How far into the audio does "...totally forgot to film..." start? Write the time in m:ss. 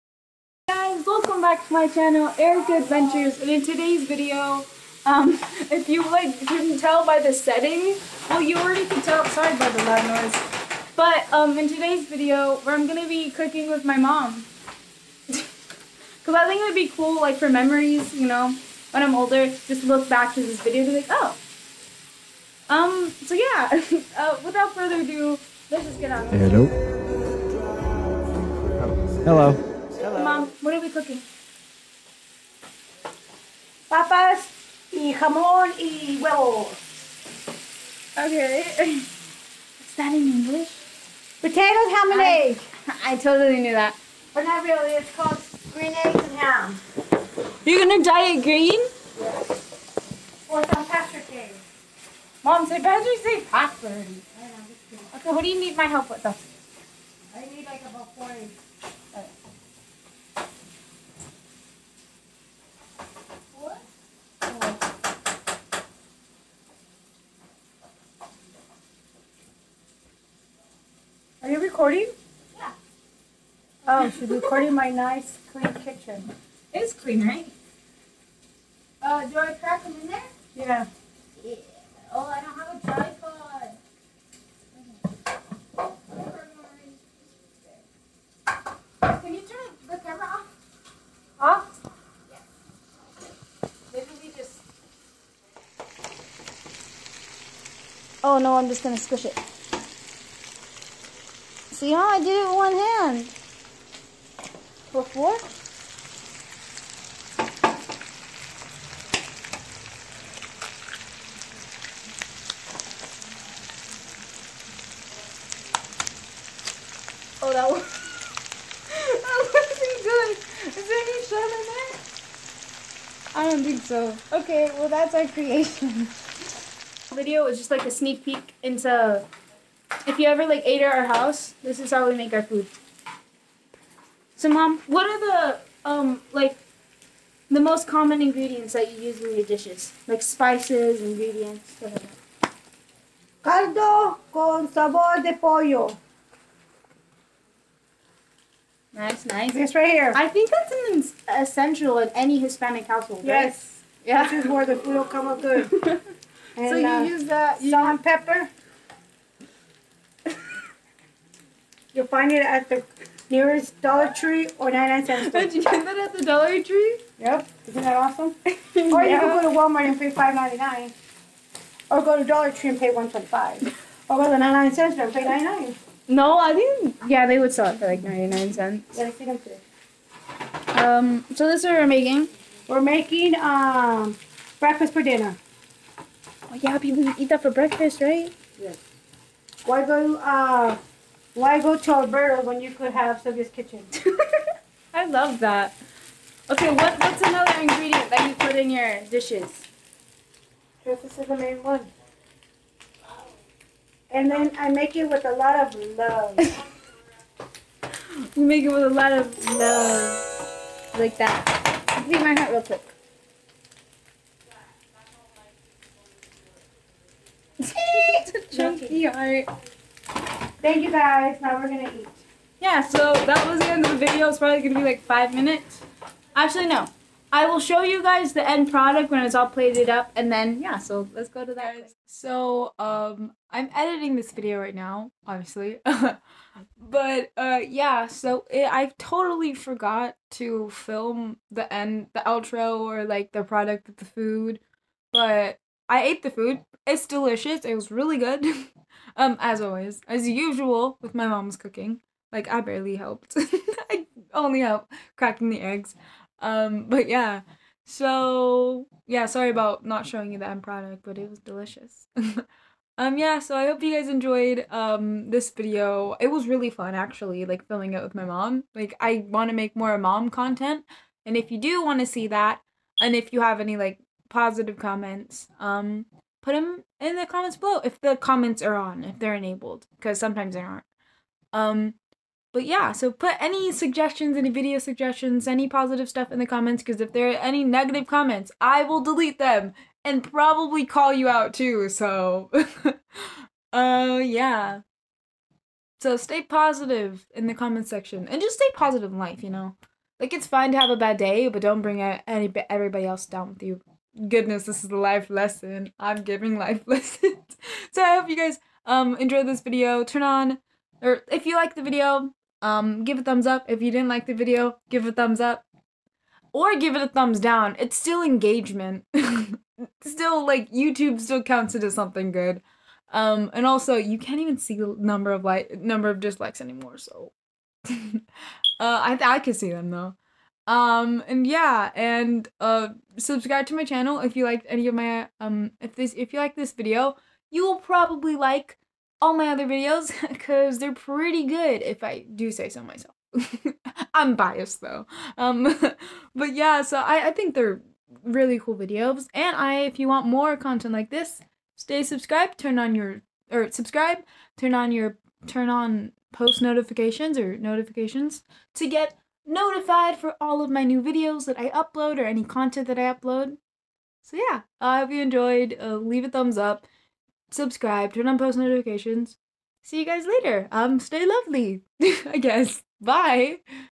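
3:58.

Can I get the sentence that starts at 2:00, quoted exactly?
Is there any shot in there?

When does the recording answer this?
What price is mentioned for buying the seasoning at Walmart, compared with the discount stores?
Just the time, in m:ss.
2:50.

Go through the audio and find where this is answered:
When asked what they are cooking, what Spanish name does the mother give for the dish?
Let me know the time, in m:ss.
0:33.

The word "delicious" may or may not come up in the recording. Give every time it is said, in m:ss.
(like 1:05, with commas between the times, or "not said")
4:07, 4:21.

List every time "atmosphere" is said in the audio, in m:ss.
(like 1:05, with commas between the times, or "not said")
not said.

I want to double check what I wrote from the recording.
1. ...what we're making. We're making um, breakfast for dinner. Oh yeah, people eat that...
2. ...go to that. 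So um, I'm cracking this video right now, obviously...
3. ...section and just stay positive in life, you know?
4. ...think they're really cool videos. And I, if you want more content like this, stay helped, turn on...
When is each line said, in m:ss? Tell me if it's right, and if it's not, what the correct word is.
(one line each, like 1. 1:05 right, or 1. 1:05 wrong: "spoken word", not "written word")
1. 3:01 right
2. 3:51 wrong: "editing", not "cracking"
3. 4:57 right
4. 5:47 wrong: "subscribed", not "helped".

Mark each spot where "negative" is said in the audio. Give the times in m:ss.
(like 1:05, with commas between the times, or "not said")
4:47.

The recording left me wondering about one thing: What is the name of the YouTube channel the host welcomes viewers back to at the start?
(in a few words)
Erica Adventures.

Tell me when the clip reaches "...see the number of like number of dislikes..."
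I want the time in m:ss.
5:24.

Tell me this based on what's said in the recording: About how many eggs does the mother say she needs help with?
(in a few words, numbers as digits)
40.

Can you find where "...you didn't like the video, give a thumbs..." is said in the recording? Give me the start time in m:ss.
5:13.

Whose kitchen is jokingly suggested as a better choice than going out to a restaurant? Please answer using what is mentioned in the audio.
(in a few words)
Sylvia's kitchen.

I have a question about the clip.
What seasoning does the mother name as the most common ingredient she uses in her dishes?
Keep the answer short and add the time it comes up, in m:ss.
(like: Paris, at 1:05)
Caldo con sabor de pollo, at 2:23.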